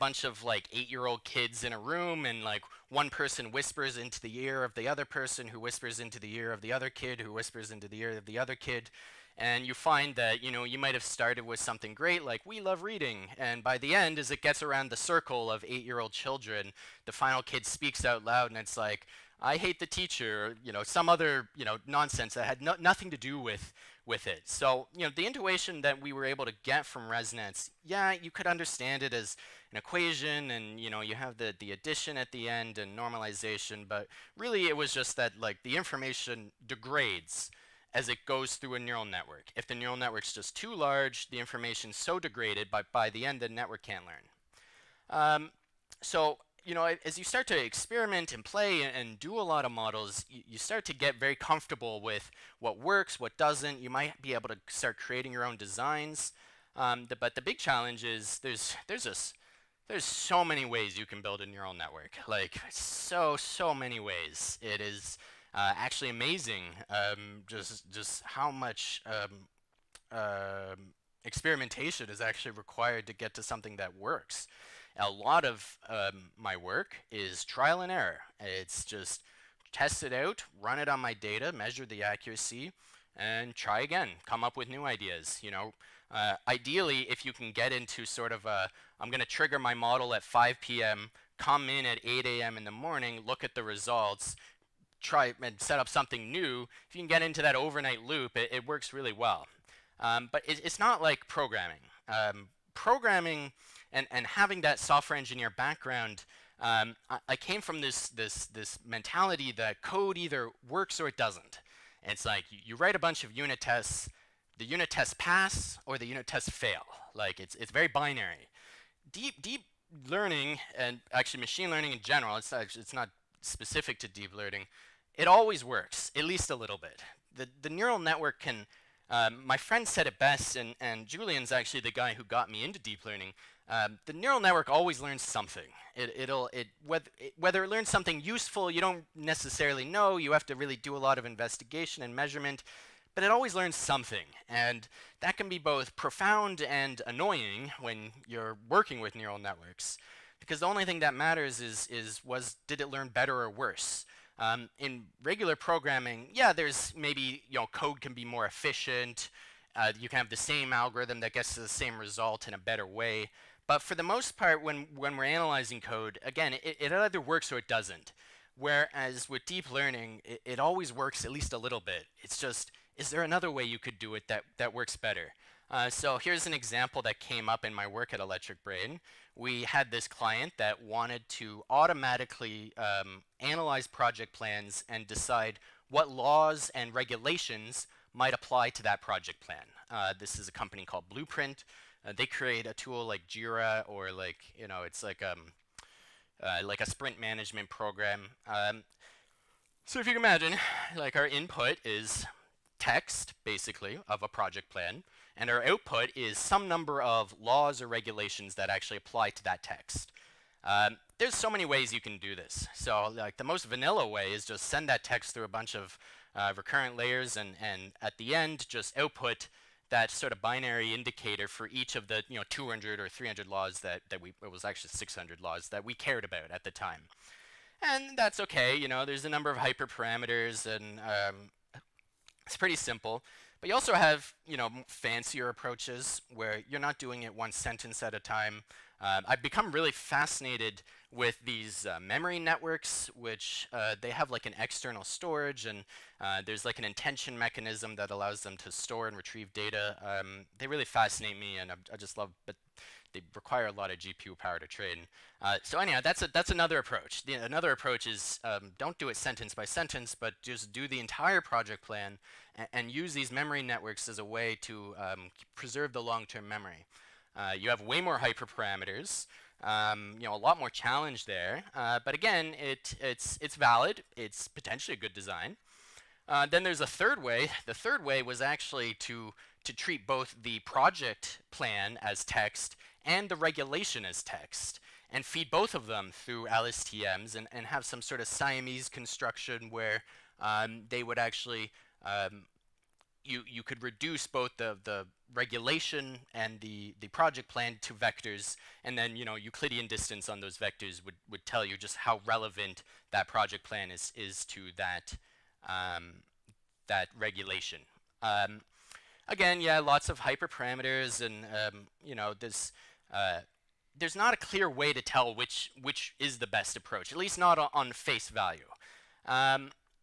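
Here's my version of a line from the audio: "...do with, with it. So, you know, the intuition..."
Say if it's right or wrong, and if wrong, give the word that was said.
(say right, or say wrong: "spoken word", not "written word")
right.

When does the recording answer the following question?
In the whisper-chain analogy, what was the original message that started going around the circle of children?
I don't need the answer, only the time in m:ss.
0:12.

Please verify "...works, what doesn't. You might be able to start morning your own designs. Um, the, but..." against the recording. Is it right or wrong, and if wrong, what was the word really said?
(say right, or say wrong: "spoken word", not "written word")
wrong: "creating", not "morning".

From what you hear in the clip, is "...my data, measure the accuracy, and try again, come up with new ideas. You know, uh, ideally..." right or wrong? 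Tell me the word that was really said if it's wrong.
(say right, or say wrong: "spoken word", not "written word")
right.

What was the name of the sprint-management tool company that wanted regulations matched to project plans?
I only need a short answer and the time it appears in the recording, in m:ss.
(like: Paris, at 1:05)
Blueprint, at 3:11.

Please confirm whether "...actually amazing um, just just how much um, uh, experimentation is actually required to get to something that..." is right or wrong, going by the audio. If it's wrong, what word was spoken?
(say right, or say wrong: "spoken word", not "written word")
right.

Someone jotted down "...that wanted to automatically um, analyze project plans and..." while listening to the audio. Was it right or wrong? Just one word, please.
right.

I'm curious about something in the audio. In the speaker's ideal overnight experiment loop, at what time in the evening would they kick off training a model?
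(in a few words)
5 p.m.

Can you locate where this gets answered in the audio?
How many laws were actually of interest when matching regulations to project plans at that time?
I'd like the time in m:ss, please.
3:44.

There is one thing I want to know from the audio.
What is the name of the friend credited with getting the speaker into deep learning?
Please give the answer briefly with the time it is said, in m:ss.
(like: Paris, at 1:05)
Julian, at 2:11.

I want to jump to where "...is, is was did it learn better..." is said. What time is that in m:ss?
2:31.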